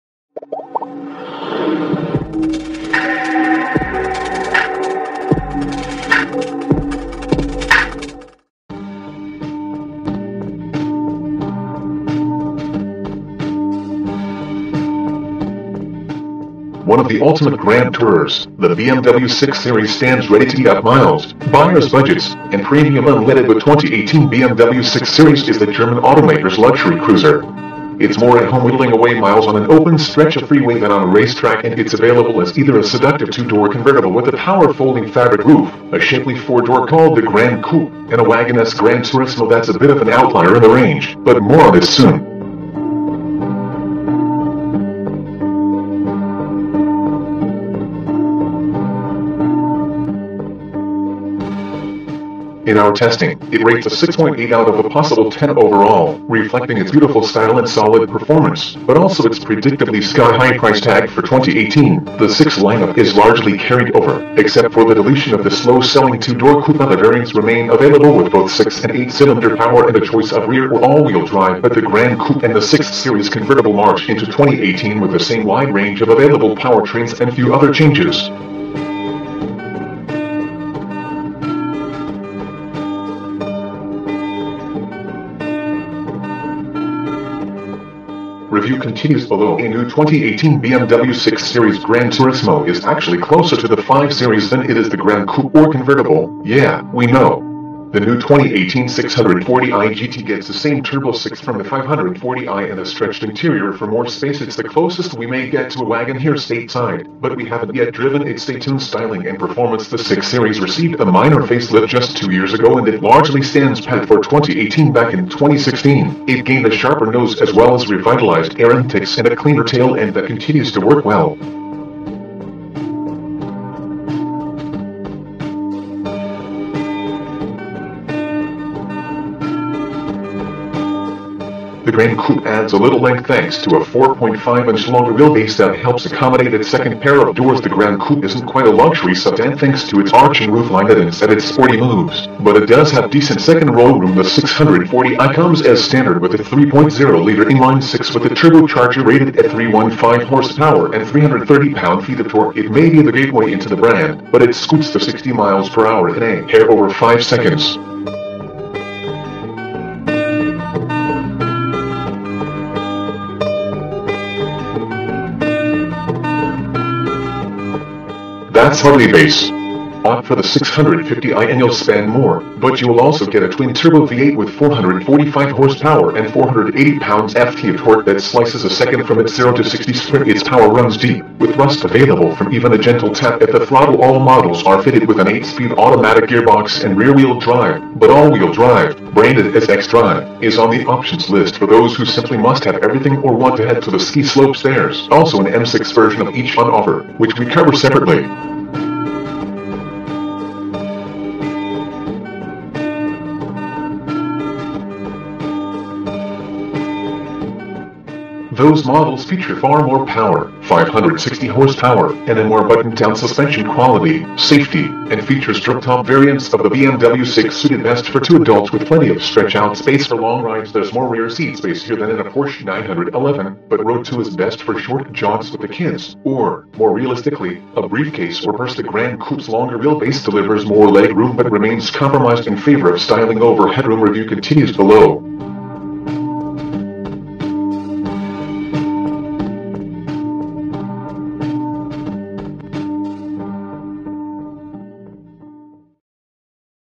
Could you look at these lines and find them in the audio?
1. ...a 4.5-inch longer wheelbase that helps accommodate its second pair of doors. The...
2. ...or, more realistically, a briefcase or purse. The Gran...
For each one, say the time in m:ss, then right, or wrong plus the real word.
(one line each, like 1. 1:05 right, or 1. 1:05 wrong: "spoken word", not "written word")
1. 2:13 right
2. 3:46 right.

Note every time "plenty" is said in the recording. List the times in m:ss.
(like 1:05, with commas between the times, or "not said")
3:38.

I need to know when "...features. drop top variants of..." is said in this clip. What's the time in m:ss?
3:35.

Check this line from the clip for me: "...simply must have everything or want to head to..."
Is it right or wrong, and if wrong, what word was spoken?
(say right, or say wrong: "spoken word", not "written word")
right.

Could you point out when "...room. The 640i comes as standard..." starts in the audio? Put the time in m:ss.
2:23.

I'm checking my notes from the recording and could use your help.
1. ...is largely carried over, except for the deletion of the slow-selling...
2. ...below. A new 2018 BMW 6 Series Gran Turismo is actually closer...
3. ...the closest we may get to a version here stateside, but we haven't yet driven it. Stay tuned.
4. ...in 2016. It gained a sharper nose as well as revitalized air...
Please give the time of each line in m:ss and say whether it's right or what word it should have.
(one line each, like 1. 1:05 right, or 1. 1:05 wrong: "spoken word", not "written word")
1. 1:02 right
2. 1:29 right
3. 1:44 wrong: "wagon", not "version"
4. 1:55 right.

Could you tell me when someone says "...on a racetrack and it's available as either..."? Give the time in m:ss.
0:30.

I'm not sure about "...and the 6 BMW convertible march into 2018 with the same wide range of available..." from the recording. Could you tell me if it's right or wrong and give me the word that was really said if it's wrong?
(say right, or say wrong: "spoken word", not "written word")
wrong: "Series", not "BMW".